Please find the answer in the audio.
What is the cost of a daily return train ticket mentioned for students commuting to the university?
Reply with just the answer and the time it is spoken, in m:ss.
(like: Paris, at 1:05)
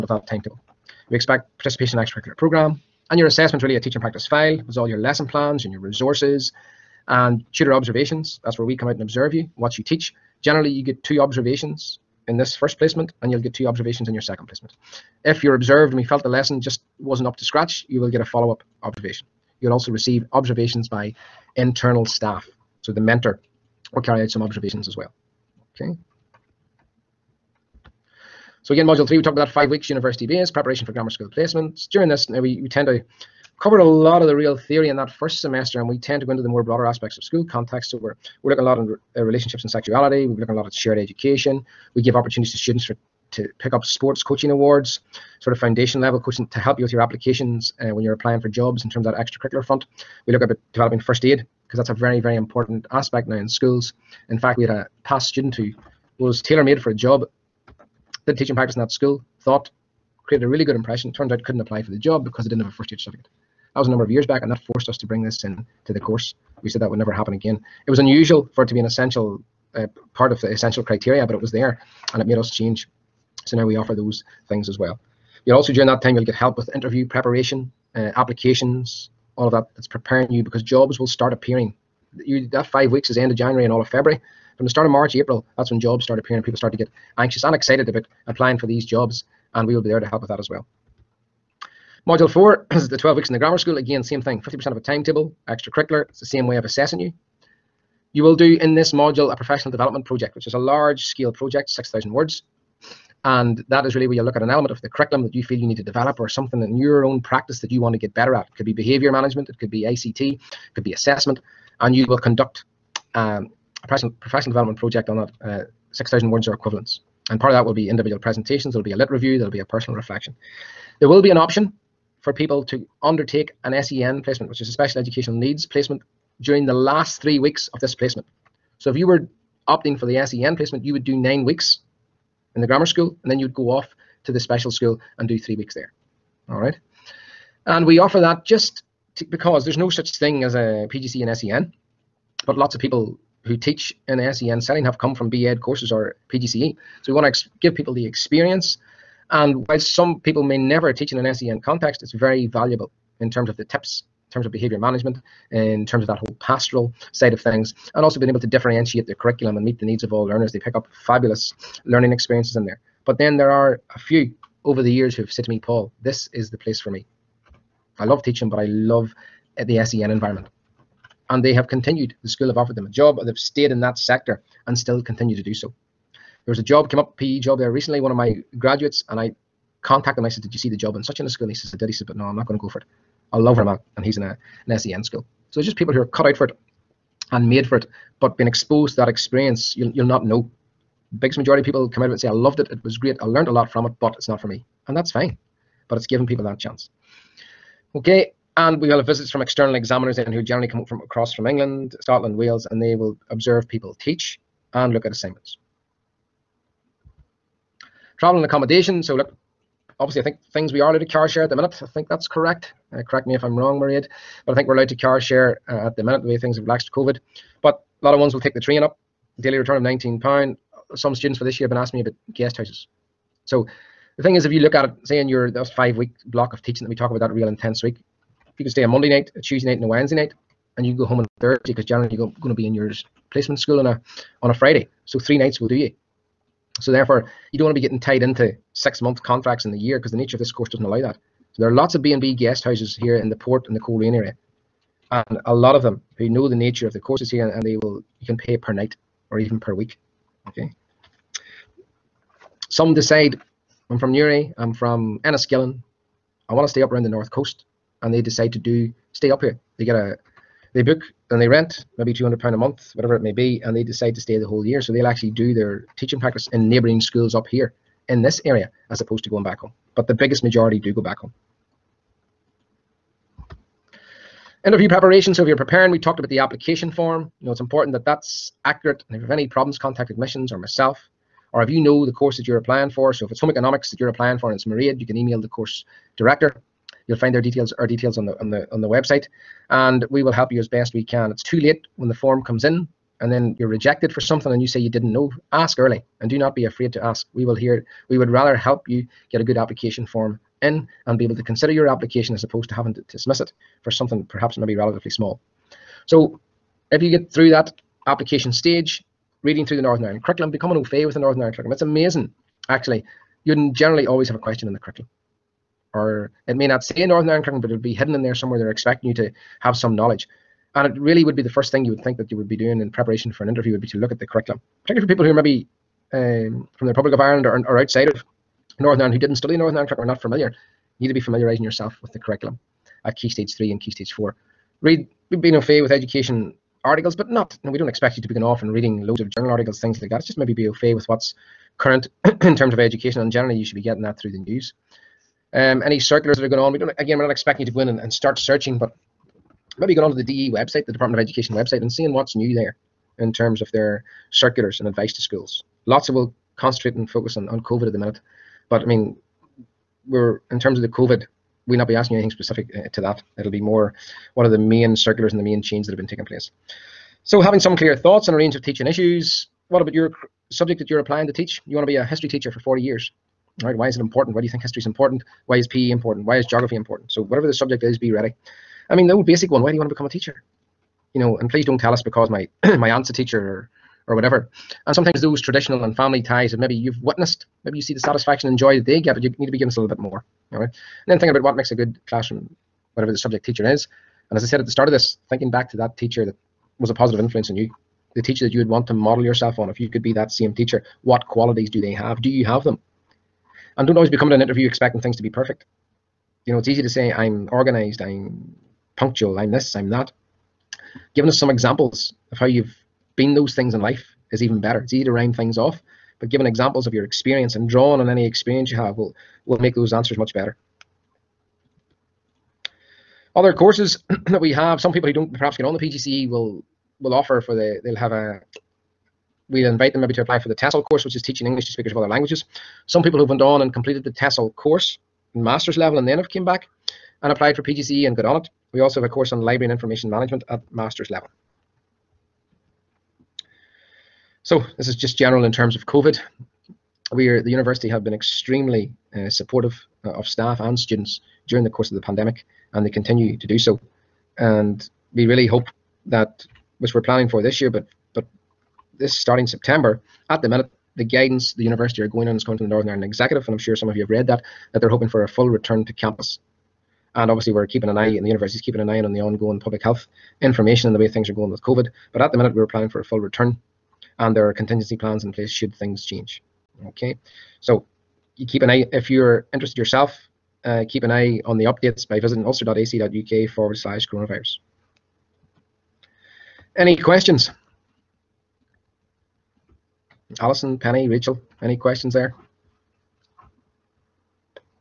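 £19, at 3:39.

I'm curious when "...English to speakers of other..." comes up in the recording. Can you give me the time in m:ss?
7:11.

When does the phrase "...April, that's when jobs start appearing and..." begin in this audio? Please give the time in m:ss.
1:25.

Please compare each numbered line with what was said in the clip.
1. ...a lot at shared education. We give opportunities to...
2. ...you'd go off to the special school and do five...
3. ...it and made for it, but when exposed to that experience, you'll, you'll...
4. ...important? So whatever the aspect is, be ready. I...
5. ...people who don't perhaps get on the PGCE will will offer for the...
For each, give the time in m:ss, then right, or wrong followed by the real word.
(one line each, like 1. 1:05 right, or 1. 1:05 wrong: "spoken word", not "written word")
1. 0:40 right
2. 2:13 wrong: "three", not "five"
3. 3:06 right
4. 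6:16 wrong: "subject", not "aspect"
5. 7:04 right.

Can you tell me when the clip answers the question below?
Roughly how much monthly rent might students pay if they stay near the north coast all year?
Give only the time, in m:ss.
4:22.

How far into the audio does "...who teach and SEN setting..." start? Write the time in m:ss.
2:23.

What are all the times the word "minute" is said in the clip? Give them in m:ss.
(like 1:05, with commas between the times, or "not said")
3:31, 3:36, 5:57, 7:40, 7:52.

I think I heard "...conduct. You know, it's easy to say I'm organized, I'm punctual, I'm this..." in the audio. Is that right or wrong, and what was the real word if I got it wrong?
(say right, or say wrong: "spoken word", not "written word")
wrong: "perfect", not "conduct".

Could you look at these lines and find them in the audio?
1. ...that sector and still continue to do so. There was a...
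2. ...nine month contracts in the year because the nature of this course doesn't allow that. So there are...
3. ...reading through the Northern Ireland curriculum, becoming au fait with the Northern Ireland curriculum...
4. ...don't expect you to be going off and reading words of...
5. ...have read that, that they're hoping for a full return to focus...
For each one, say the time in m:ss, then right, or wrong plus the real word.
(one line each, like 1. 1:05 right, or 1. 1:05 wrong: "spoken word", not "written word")
1. 2:53 right
2. 3:58 wrong: "six", not "nine"
3. 5:09 right
4. 5:37 wrong: "loads", not "words"
5. 7:44 wrong: "campus", not "focus".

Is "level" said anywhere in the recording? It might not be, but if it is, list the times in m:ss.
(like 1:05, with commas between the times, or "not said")
0:45, 7:15, 7:21.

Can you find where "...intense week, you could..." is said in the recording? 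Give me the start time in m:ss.
3:47.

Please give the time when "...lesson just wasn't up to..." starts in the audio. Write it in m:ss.
0:16.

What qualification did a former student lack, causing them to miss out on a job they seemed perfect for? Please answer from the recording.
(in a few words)
First aid certificate.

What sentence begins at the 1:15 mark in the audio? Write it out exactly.
You'll also during that time you'll get help with interview preparation, uh, applications, all of that.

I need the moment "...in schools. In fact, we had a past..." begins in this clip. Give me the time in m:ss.
0:53.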